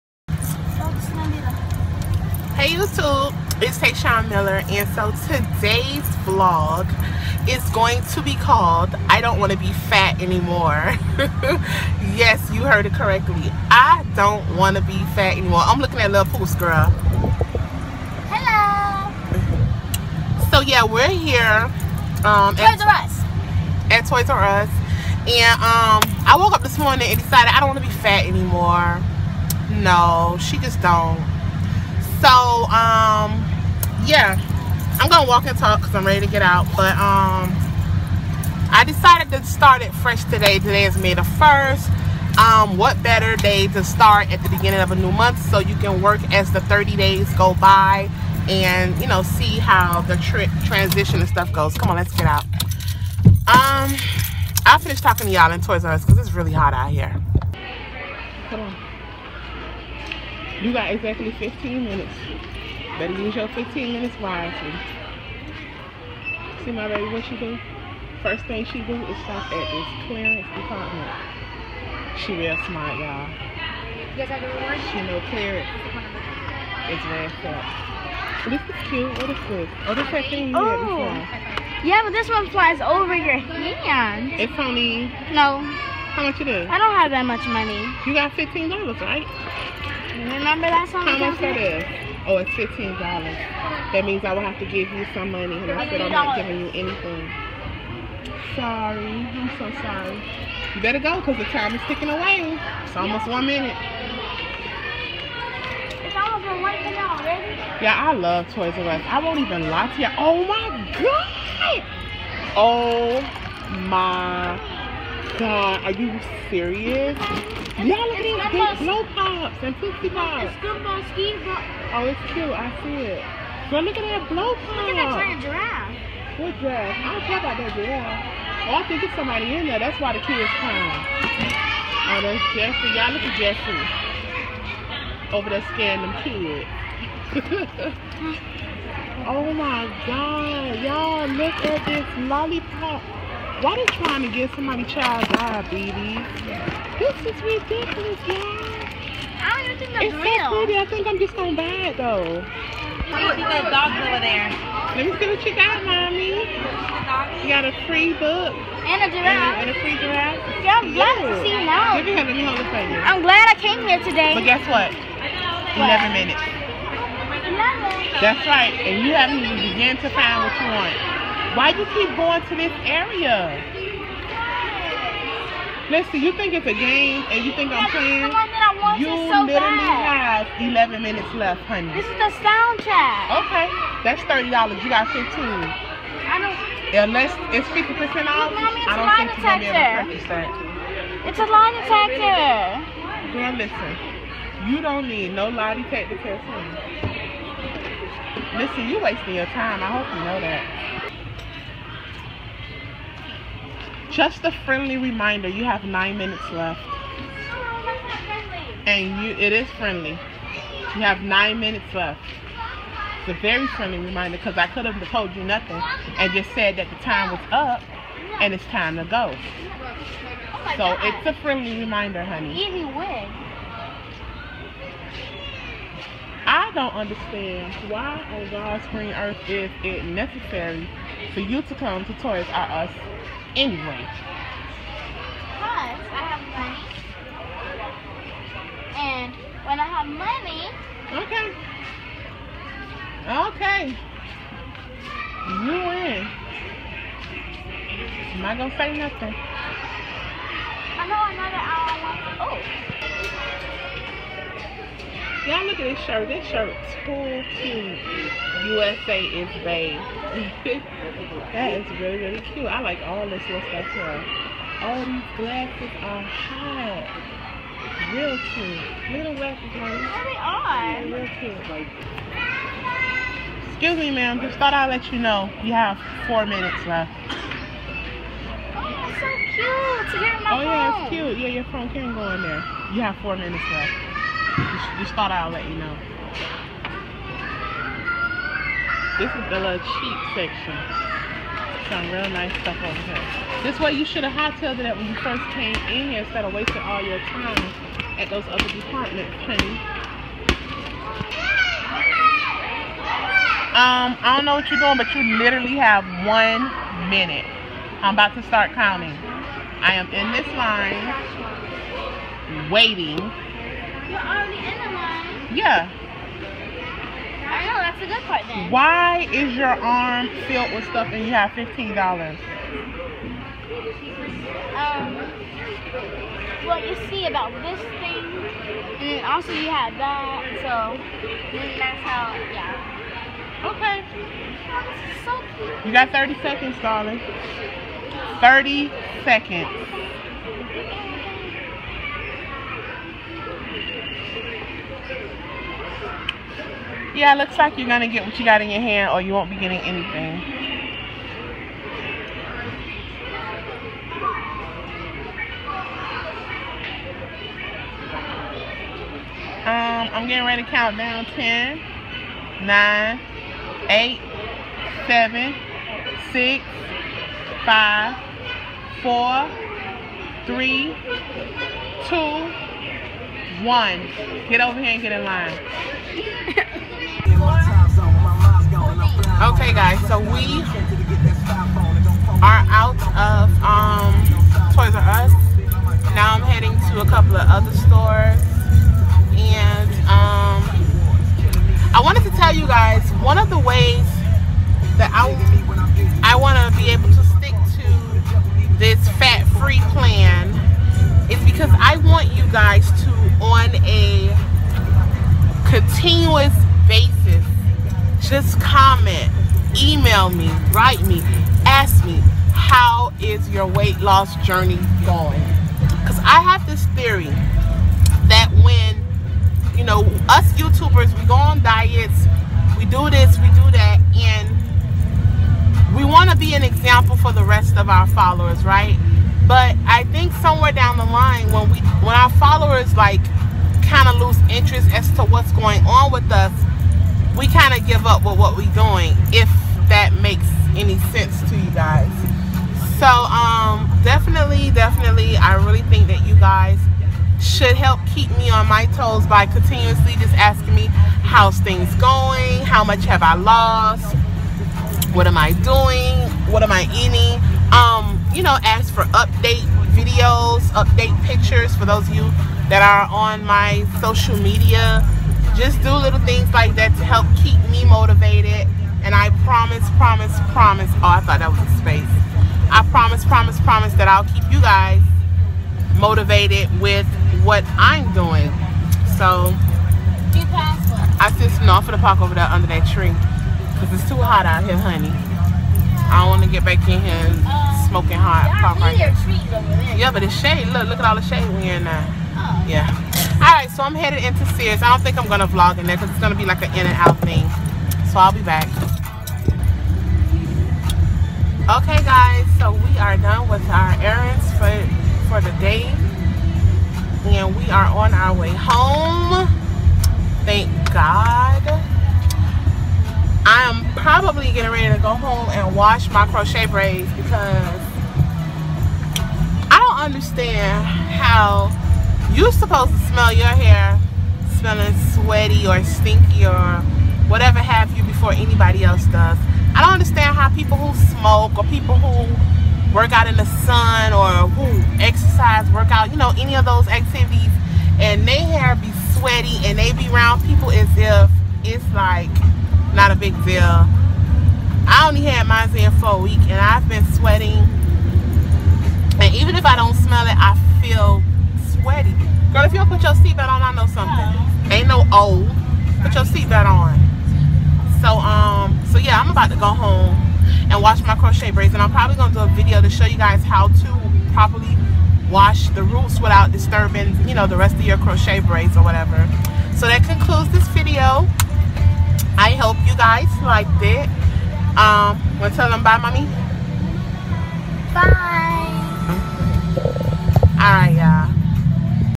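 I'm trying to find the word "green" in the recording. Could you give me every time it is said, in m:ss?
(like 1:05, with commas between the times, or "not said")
3:48.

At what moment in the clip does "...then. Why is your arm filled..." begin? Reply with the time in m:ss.
5:18.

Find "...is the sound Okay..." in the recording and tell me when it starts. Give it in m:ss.
3:02.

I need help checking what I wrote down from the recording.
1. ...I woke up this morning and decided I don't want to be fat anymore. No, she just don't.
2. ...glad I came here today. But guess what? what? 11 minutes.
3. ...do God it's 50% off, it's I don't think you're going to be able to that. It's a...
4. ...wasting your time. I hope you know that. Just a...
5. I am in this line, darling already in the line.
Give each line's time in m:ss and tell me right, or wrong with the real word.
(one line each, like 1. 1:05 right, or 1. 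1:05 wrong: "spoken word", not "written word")
1. 0:26 right
2. 2:43 right
3. 3:06 wrong: "Unless", not "God"
4. 3:19 right
5. 5:09 wrong: "waiting", not "darling".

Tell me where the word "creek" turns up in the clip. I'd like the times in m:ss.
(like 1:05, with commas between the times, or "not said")
not said.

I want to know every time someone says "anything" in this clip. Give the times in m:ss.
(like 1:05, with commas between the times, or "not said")
1:36, 5:49.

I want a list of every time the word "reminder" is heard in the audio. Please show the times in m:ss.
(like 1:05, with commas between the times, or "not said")
3:24, 3:33, 3:41.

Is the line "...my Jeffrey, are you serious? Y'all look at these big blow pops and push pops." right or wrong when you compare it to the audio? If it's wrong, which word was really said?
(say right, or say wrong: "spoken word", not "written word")
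wrong: "God", not "Jeffrey".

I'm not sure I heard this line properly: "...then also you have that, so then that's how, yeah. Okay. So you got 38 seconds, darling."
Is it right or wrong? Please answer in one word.
wrong.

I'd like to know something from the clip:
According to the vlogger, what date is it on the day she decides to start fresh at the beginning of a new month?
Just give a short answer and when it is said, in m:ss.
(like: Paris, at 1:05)
May 1st, at 0:40.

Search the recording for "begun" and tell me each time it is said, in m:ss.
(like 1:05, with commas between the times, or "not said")
2:49.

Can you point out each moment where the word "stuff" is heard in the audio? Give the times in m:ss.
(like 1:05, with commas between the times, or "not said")
0:51, 4:23, 4:52, 5:20.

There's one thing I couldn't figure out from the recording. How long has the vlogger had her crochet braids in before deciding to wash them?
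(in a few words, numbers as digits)
a week.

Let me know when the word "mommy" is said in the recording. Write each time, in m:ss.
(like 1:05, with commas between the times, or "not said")
2:35, 9:35.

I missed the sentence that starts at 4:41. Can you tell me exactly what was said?
Yeah, your phone can go in there.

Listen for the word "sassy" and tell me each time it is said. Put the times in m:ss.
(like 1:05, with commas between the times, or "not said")
not said.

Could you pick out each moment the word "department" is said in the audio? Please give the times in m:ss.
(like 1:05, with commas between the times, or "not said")
1:10, 4:58.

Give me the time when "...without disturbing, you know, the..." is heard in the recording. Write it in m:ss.
9:26.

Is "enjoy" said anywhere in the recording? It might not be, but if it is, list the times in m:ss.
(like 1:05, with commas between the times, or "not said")
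not said.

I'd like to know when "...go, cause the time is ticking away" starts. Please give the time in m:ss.
1:40.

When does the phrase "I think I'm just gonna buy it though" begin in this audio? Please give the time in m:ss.
2:30.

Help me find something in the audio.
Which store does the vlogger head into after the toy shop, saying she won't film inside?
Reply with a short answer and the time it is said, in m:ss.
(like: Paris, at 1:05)
Sears, at 8:14.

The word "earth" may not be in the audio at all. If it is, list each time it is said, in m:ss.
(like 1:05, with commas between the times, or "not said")
3:49.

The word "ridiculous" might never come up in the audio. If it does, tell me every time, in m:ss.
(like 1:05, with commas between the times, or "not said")
2:27.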